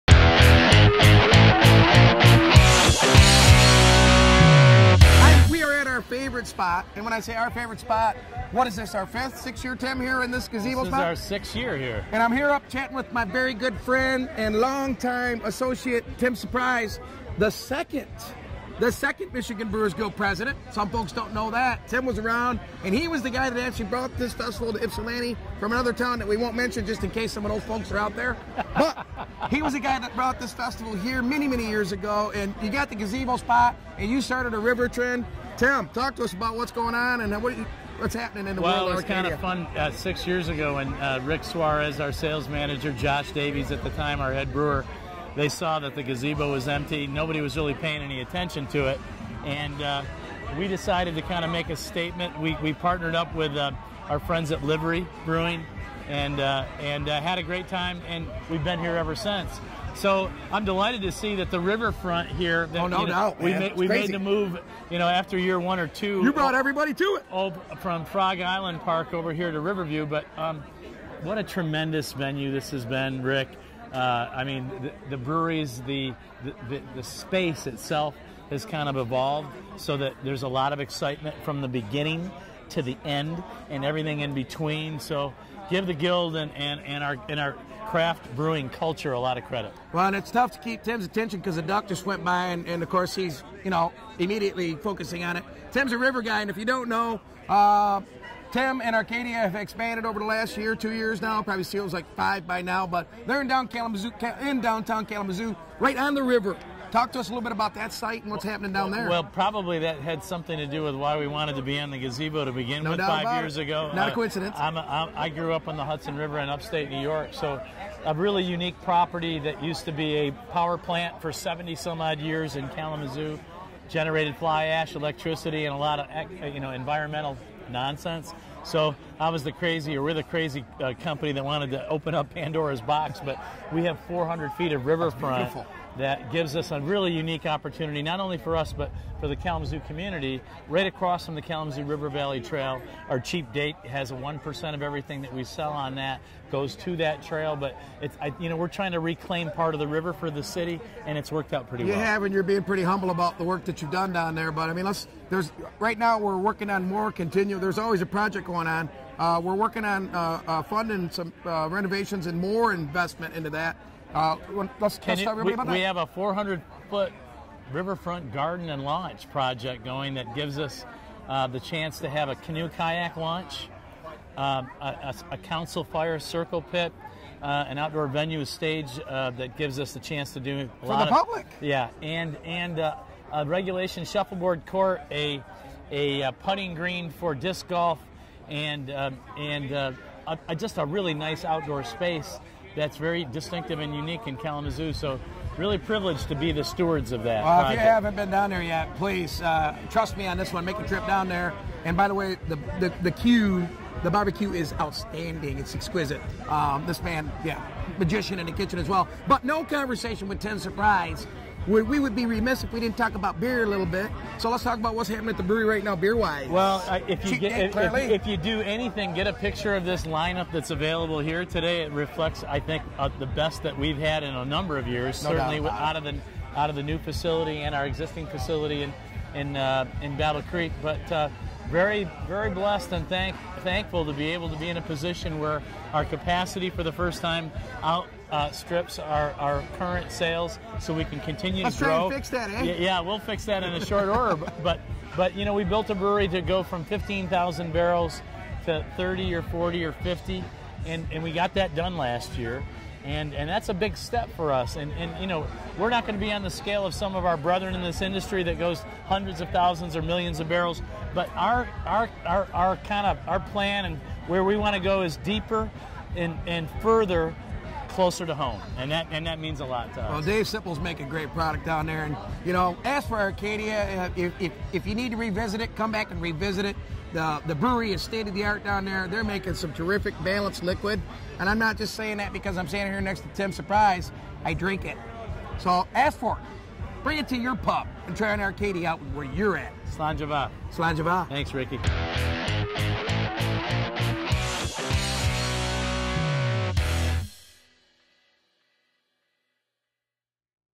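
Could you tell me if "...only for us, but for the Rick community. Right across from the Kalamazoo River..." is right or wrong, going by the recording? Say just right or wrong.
wrong.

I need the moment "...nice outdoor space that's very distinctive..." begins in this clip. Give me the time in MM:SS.
03:11.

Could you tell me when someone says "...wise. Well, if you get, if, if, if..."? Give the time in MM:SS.
03:36.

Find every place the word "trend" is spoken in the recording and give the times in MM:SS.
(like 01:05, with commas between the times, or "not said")
00:34.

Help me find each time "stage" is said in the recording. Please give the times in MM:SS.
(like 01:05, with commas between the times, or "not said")
02:58.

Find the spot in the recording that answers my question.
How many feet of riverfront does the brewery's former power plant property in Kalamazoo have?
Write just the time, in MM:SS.
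02:14.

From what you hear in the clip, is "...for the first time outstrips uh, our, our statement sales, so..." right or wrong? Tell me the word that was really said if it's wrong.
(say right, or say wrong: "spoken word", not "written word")
wrong: "current", not "statement".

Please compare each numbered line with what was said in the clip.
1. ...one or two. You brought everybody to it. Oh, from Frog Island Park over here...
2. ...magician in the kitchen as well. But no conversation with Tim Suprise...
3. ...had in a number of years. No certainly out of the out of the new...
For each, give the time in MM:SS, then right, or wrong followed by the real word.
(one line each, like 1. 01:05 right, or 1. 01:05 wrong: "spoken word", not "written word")
1. 01:05 right
2. 03:27 right
3. 03:43 right.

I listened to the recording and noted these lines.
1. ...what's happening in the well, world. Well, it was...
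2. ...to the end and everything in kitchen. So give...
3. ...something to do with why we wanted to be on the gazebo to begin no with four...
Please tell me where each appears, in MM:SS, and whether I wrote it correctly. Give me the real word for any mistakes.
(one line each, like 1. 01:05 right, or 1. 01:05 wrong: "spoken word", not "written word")
1. 00:37 right
2. 01:22 wrong: "between", not "kitchen"
3. 01:50 wrong: "five", not "four".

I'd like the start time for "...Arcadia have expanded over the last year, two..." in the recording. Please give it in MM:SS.
01:38.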